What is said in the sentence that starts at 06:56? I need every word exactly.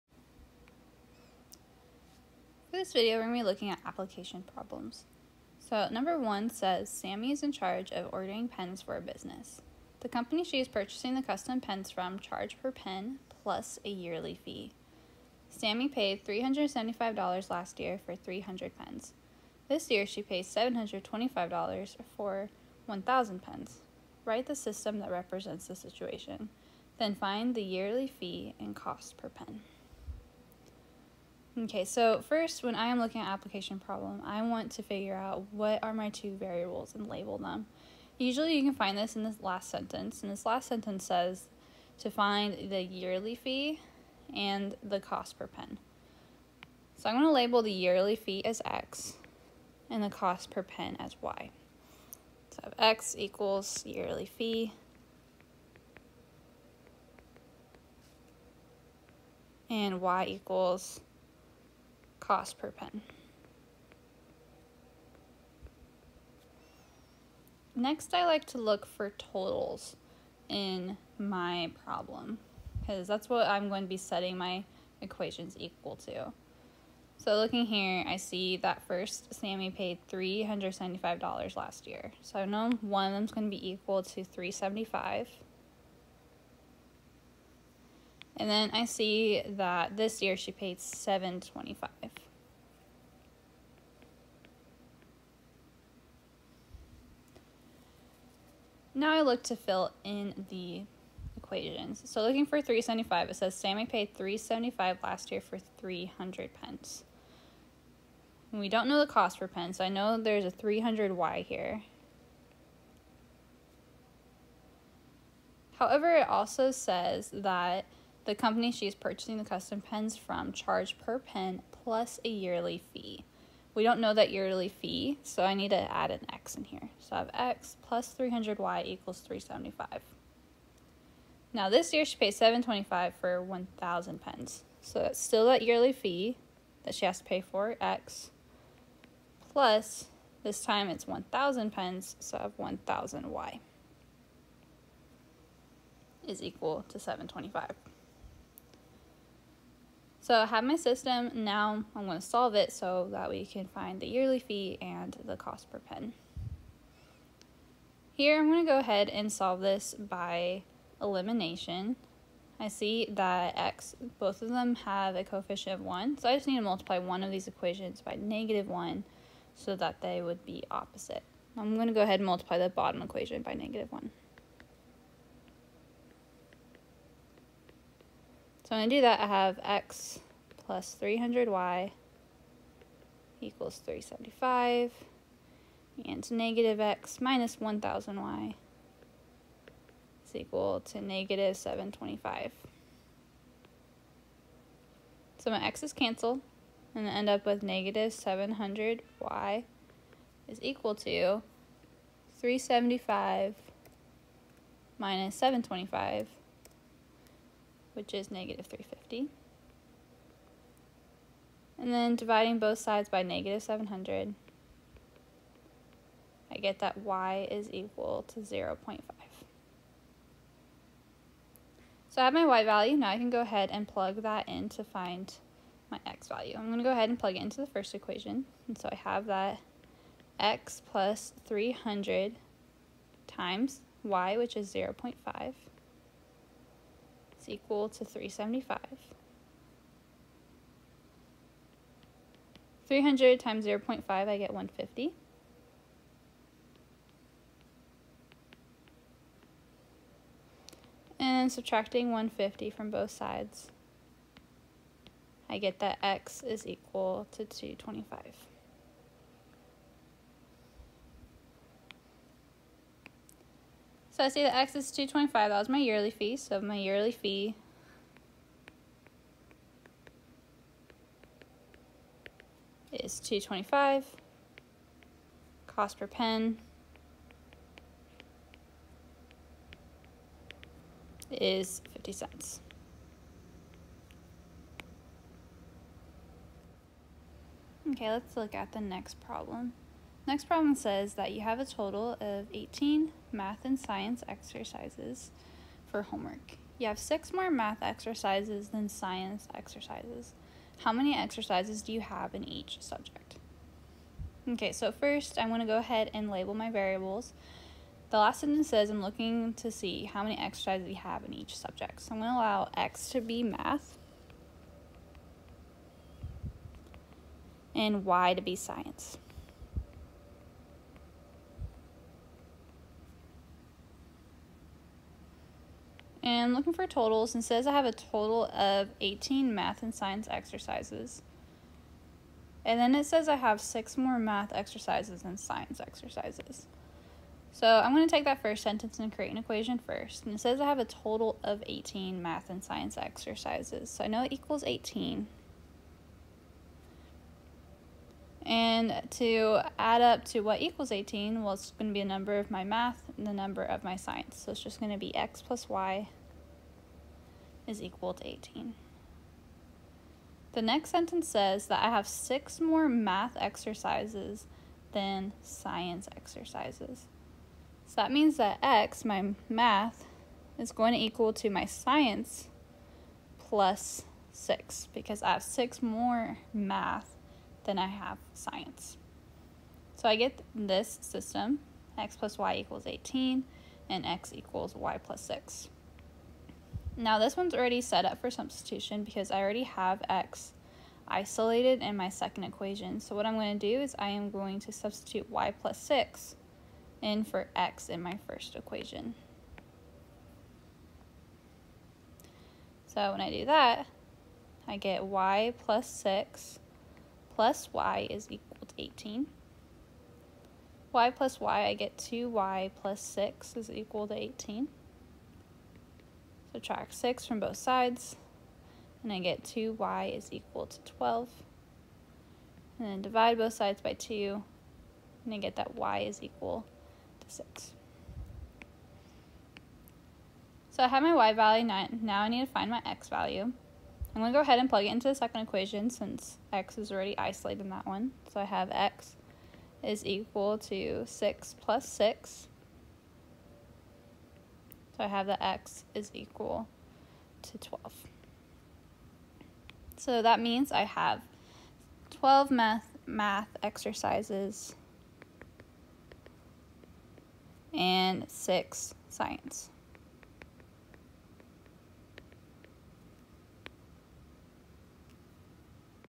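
Subtract 6 from both sides, and I get 2y is equal to 12.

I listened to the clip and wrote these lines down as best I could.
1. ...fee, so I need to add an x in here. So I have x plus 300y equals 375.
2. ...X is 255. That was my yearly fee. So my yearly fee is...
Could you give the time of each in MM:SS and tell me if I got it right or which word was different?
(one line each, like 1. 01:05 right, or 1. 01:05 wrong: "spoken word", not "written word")
1. 02:04 right
2. 04:24 wrong: "225", not "255".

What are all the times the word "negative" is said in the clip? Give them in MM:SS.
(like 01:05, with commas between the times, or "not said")
02:48, 02:53, 03:06, 03:11, 03:17, 03:28, 03:33.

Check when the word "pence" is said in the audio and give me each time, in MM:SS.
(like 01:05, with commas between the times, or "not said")
01:46, 02:21.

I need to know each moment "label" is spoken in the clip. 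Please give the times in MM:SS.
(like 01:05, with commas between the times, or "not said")
00:37, 00:47, 05:06.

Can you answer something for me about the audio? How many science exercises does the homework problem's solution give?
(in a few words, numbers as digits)
6.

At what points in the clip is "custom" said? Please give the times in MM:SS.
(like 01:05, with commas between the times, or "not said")
00:11, 01:59.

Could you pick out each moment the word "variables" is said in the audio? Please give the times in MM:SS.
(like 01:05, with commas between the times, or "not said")
00:36, 05:06.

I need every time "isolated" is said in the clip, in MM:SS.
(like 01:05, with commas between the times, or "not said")
06:31, 07:17.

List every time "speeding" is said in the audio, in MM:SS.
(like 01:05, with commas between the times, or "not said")
not said.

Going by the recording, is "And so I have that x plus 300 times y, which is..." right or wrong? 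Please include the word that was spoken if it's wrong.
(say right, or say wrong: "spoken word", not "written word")
right.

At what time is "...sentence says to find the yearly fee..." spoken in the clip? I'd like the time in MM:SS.
00:40.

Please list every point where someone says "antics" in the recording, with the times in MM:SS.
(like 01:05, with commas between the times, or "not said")
not said.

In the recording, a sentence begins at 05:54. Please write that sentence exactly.
So it's just going to be x plus y is equal to 18.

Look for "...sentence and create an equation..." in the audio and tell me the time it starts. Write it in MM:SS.
05:38.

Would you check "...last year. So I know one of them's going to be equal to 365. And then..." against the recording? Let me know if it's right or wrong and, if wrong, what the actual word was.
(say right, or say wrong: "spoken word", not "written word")
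wrong: "375", not "365".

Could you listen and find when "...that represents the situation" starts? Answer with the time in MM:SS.
00:25.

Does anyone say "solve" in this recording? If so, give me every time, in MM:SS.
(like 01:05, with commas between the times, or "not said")
02:32, 02:39.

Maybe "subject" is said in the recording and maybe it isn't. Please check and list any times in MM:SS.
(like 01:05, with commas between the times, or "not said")
05:02, 05:11.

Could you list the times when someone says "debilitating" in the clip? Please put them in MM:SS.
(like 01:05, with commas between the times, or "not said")
not said.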